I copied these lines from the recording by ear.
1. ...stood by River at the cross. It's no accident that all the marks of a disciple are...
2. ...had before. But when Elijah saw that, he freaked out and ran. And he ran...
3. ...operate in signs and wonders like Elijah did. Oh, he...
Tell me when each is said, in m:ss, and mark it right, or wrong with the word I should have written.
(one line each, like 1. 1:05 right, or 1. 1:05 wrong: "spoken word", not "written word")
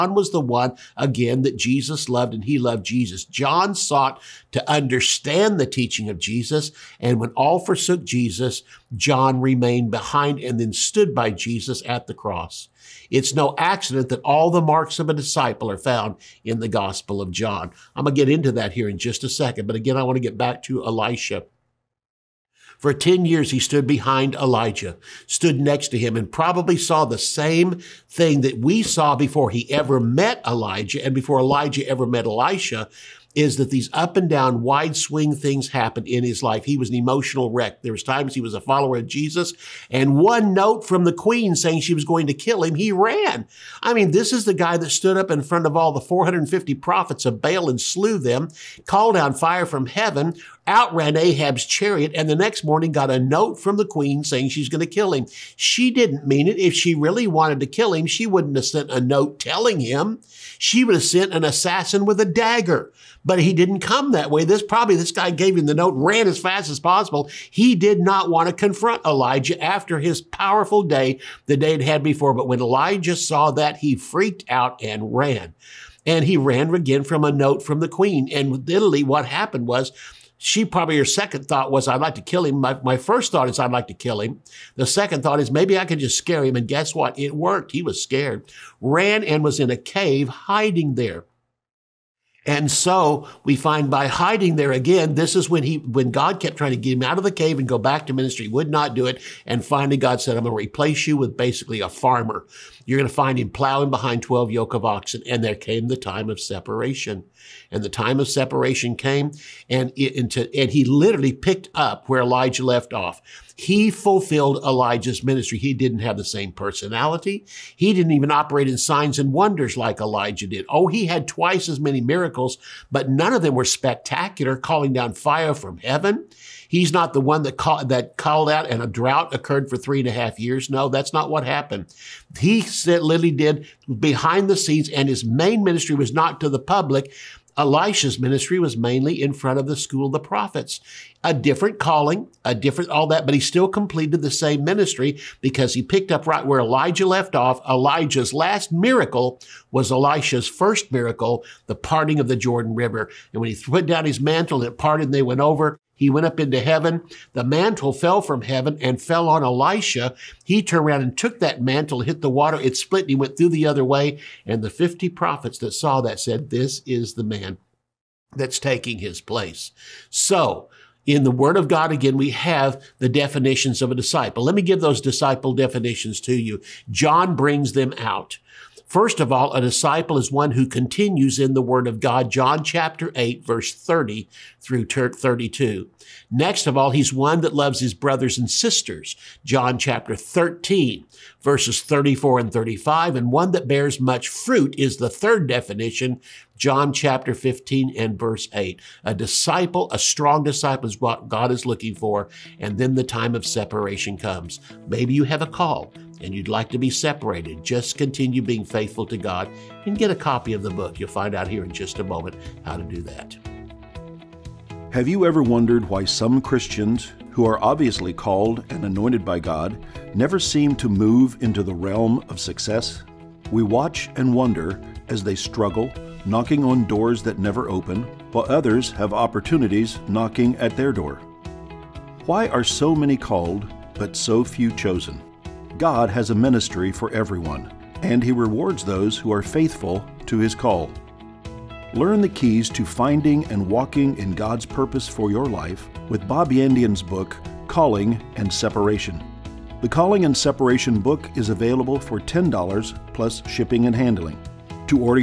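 1. 0:10 wrong: "Jesus", not "River"
2. 1:11 right
3. 1:58 right.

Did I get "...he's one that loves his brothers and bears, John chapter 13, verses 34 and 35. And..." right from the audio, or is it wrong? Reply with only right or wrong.
wrong.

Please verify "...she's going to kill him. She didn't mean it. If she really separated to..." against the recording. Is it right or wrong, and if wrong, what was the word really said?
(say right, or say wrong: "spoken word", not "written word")
wrong: "wanted", not "separated".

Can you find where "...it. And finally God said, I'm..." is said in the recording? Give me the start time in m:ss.
1:39.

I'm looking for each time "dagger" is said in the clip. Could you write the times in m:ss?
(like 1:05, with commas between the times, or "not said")
1:02.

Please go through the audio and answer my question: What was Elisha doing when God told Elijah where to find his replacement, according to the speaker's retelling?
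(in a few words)
Plowing behind 12 yoke of oxen.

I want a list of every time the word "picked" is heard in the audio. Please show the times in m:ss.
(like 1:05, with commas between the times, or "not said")
1:51, 2:25.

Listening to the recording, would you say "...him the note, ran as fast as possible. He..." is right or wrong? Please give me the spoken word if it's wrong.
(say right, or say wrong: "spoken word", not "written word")
right.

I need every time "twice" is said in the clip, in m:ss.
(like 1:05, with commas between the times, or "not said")
2:01.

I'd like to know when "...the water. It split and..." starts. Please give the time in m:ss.
2:42.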